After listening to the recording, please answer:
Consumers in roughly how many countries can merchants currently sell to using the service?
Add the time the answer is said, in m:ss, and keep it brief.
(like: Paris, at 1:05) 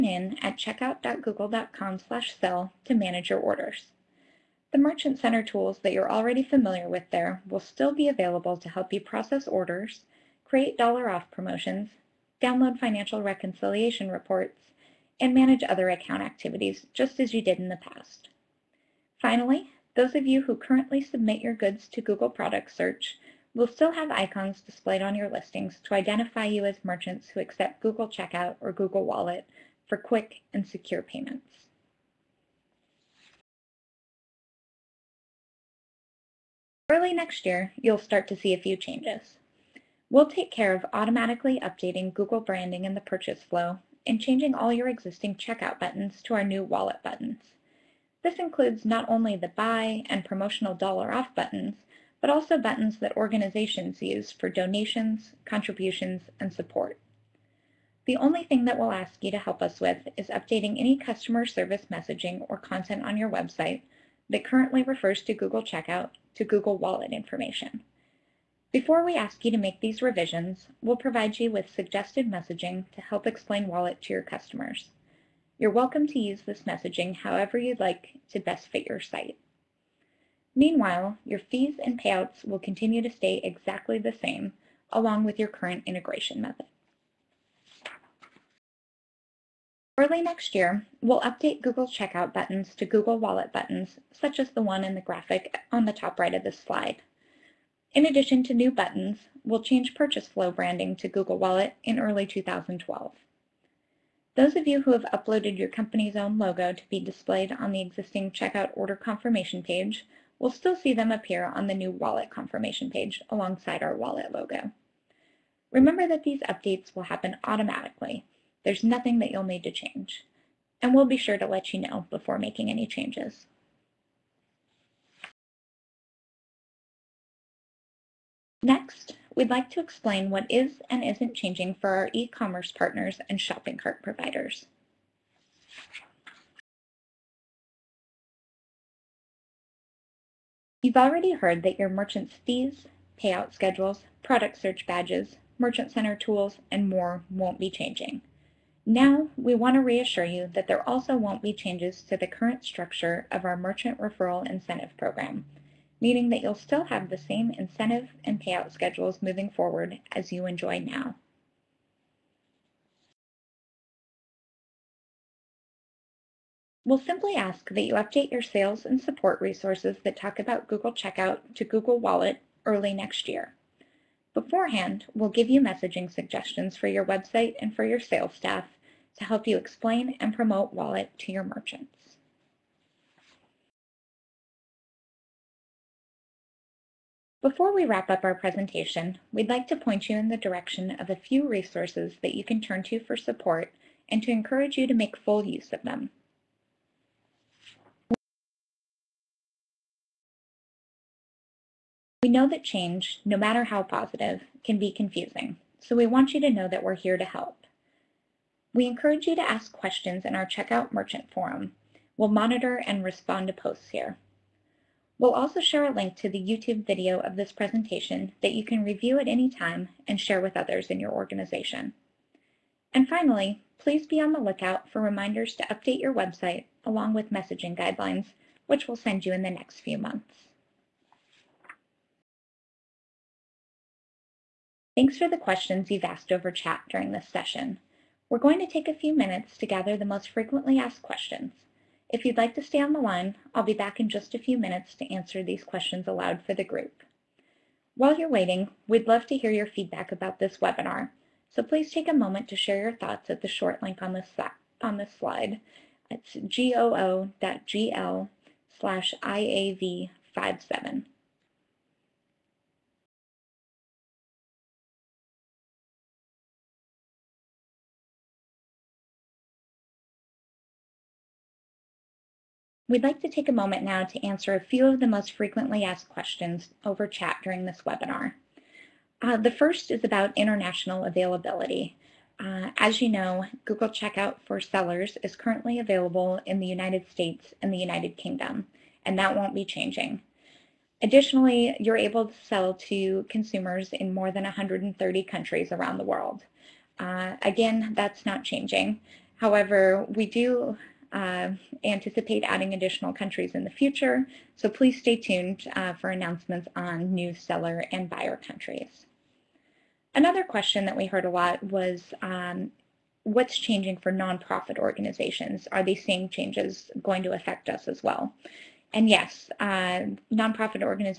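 130, at 4:54.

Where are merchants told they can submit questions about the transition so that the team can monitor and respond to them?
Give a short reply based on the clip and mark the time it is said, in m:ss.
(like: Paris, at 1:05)
Checkout Merchant Forum, at 3:30.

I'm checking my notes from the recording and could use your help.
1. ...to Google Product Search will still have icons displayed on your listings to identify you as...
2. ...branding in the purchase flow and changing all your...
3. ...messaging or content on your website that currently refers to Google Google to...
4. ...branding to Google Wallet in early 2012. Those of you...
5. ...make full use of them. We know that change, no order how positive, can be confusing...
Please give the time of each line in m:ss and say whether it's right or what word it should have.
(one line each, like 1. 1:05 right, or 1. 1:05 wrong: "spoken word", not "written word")
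1. 0:21 right
2. 0:42 right
3. 1:01 wrong: "Checkout", not "Google"
4. 1:40 right
5. 3:14 wrong: "matter", not "order".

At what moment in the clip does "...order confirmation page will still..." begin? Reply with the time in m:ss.
1:48.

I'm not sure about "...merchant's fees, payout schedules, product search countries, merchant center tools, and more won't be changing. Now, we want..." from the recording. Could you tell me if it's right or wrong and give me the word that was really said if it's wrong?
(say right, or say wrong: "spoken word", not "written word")
wrong: "badges", not "countries".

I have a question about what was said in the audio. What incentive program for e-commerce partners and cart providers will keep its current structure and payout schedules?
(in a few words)
Merchant Referral Incentive Program.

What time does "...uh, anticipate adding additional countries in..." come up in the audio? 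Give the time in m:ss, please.
5:01.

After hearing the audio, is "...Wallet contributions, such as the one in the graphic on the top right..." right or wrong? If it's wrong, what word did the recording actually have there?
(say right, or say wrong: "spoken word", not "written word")
wrong: "buttons", not "contributions".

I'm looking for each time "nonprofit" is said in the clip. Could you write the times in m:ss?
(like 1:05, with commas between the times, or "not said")
5:14, 5:20.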